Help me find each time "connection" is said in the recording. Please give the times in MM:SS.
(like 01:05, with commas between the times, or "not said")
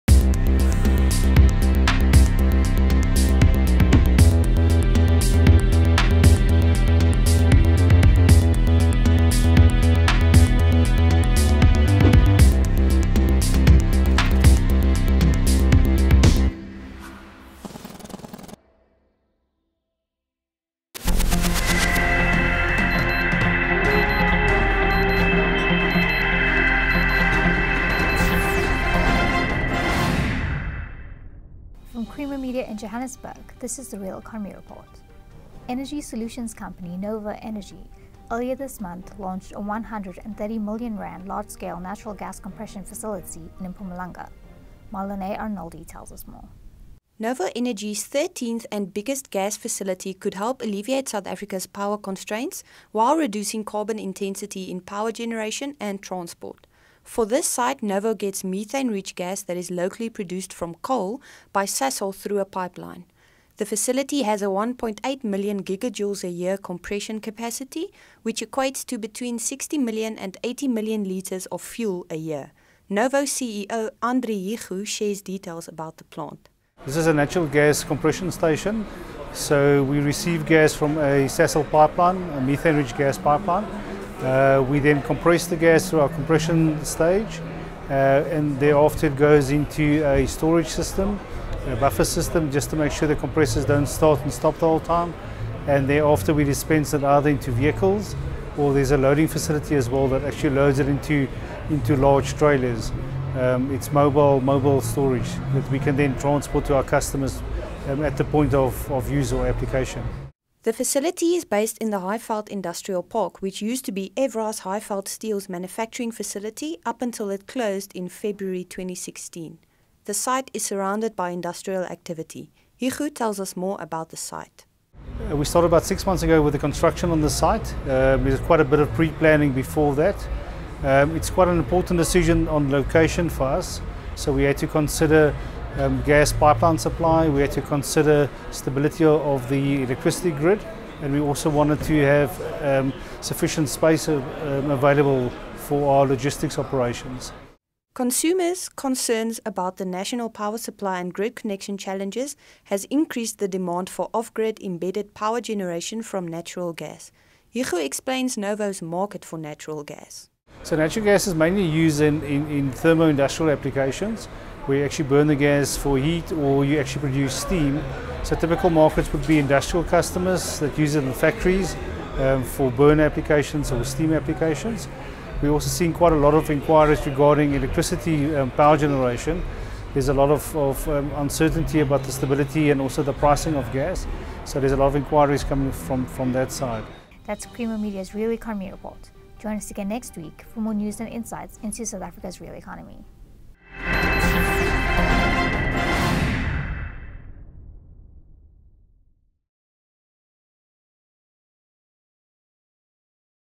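02:31.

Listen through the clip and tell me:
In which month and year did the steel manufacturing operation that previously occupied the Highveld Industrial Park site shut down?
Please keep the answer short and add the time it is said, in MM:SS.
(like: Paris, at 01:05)
February 2016, at 01:58.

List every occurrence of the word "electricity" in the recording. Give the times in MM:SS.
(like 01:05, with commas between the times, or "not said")
02:19, 02:57.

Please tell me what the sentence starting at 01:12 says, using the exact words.
Novo CEO Andri Hugo shares details about the plant.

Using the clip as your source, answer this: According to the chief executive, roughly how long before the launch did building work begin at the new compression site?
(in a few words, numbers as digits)
About six months.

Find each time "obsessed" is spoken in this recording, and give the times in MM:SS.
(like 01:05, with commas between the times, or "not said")
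not said.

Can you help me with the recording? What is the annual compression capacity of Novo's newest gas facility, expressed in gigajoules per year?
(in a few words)
1.8 million gigajoules.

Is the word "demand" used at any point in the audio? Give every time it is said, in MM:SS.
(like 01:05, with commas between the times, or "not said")
02:33.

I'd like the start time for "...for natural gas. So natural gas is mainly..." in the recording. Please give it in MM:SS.
02:39.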